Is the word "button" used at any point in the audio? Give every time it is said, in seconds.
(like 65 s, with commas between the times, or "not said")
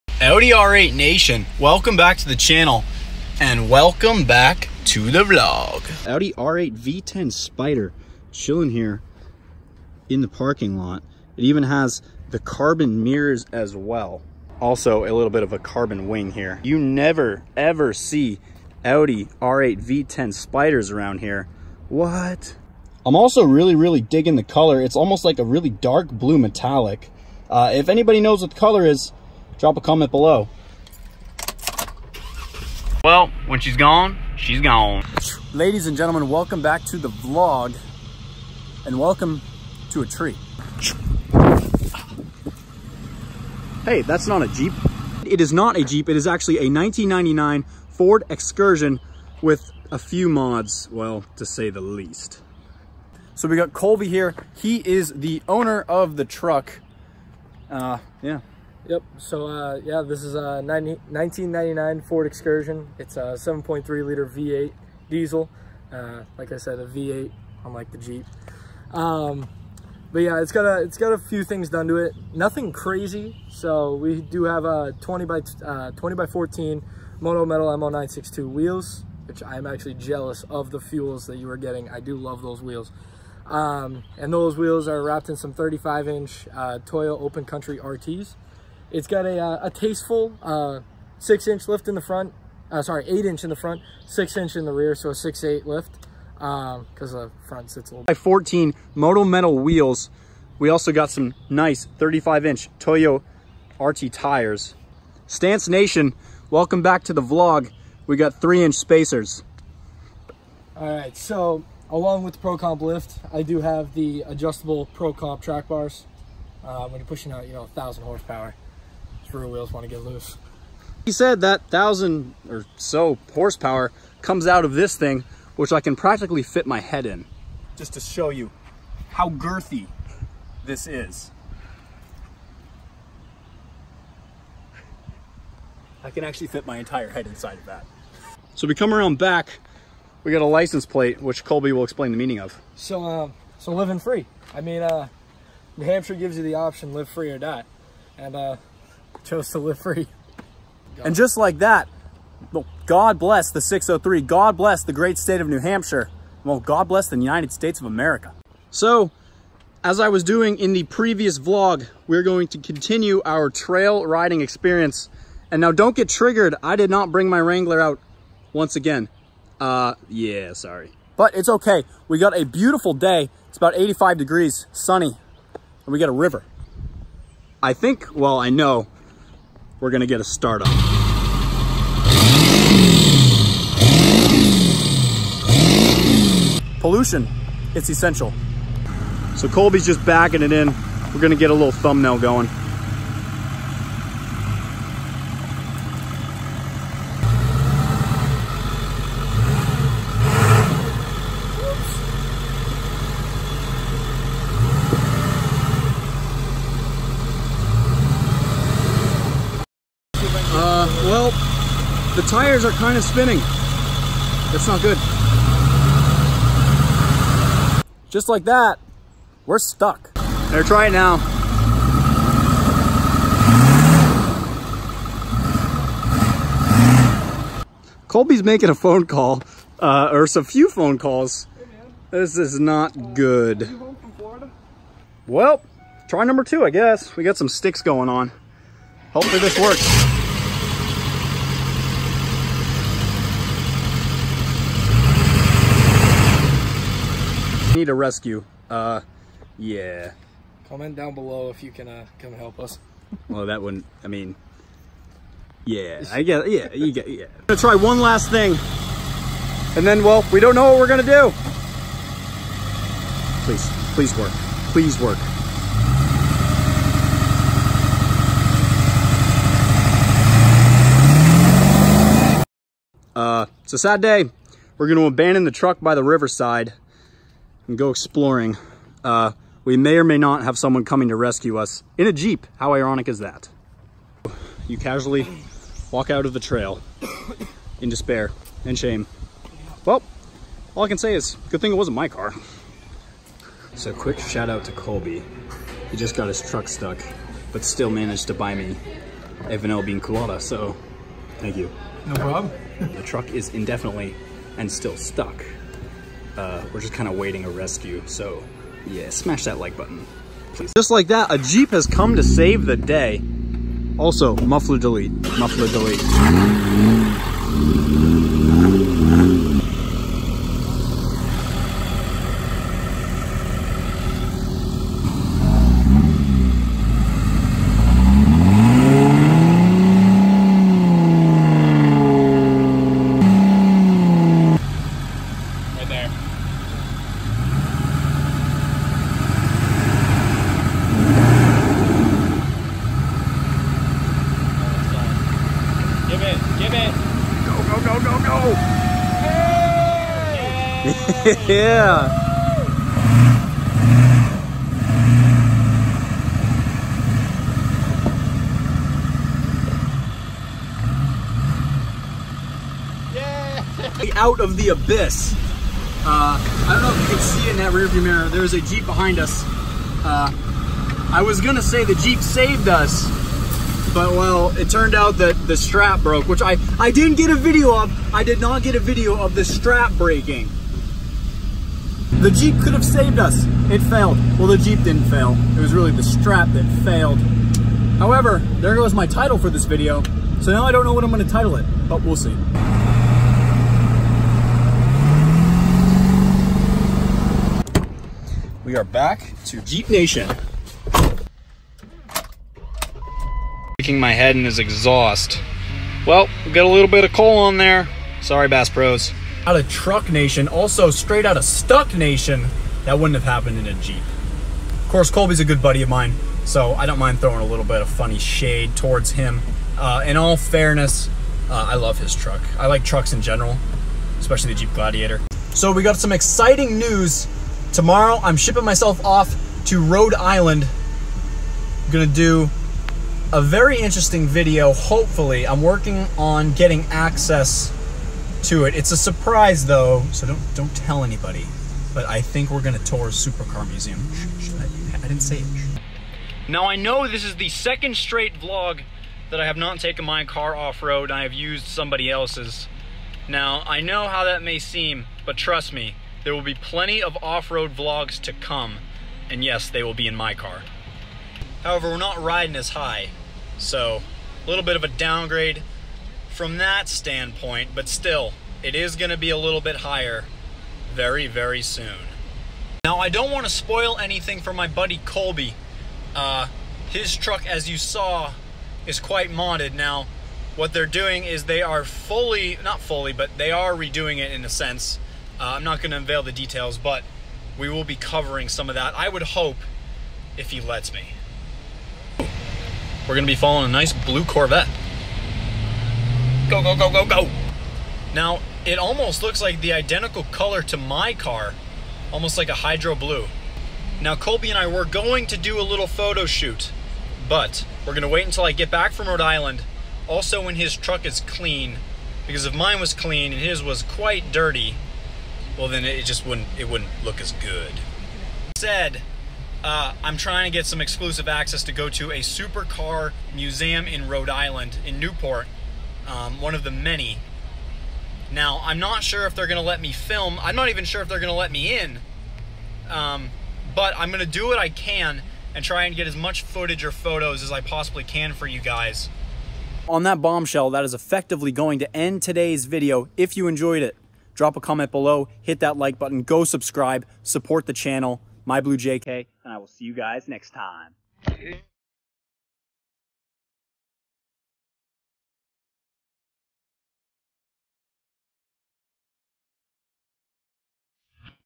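309 s, 545 s.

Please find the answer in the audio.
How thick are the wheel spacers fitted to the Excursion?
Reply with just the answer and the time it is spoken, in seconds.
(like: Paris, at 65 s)
3 inch, at 108 s.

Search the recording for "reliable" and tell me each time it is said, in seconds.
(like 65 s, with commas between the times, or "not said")
not said.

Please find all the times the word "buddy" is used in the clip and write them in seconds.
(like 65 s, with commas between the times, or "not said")
415 s, 474 s.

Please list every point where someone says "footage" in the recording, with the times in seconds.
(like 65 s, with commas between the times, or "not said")
536 s.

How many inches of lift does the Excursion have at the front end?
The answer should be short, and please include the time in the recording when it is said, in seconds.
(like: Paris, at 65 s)
8 inch, at 93 s.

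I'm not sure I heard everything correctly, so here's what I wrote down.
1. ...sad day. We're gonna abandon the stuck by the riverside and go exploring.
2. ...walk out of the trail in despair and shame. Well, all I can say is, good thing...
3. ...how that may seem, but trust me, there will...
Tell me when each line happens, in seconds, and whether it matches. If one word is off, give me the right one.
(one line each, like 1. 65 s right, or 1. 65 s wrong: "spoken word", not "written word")
1. 273 s wrong: "truck", not "stuck"
2. 285 s right
3. 454 s right.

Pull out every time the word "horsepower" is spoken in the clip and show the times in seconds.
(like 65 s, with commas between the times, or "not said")
118 s, 123 s.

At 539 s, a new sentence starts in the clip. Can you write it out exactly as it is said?
On that bombshell, that is effectively going to end today's video if you enjoyed it.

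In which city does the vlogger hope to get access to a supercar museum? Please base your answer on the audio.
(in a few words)
Newport.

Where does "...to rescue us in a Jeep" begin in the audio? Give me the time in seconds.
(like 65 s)
281 s.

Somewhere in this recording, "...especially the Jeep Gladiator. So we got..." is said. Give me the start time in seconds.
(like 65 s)
424 s.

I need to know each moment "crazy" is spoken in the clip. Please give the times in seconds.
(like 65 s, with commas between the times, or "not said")
72 s.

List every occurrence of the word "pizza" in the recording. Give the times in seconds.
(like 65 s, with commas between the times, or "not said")
not said.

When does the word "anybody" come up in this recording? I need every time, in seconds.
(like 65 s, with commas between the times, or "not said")
27 s, 441 s.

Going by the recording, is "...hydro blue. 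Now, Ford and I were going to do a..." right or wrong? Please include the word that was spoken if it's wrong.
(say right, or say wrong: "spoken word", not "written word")
wrong: "Colby", not "Ford".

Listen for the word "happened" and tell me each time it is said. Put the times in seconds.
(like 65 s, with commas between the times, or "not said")
413 s.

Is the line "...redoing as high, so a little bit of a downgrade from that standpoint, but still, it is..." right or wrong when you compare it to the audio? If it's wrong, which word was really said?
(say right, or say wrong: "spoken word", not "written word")
wrong: "riding", not "redoing".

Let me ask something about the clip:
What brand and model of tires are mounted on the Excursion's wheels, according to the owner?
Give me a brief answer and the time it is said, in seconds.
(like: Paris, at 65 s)
Toyo Open Country RTs, at 86 s.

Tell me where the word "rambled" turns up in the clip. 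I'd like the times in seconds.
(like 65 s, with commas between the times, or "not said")
not said.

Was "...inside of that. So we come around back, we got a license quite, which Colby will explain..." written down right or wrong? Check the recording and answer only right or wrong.
wrong.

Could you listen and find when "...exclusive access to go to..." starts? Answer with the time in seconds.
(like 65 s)
520 s.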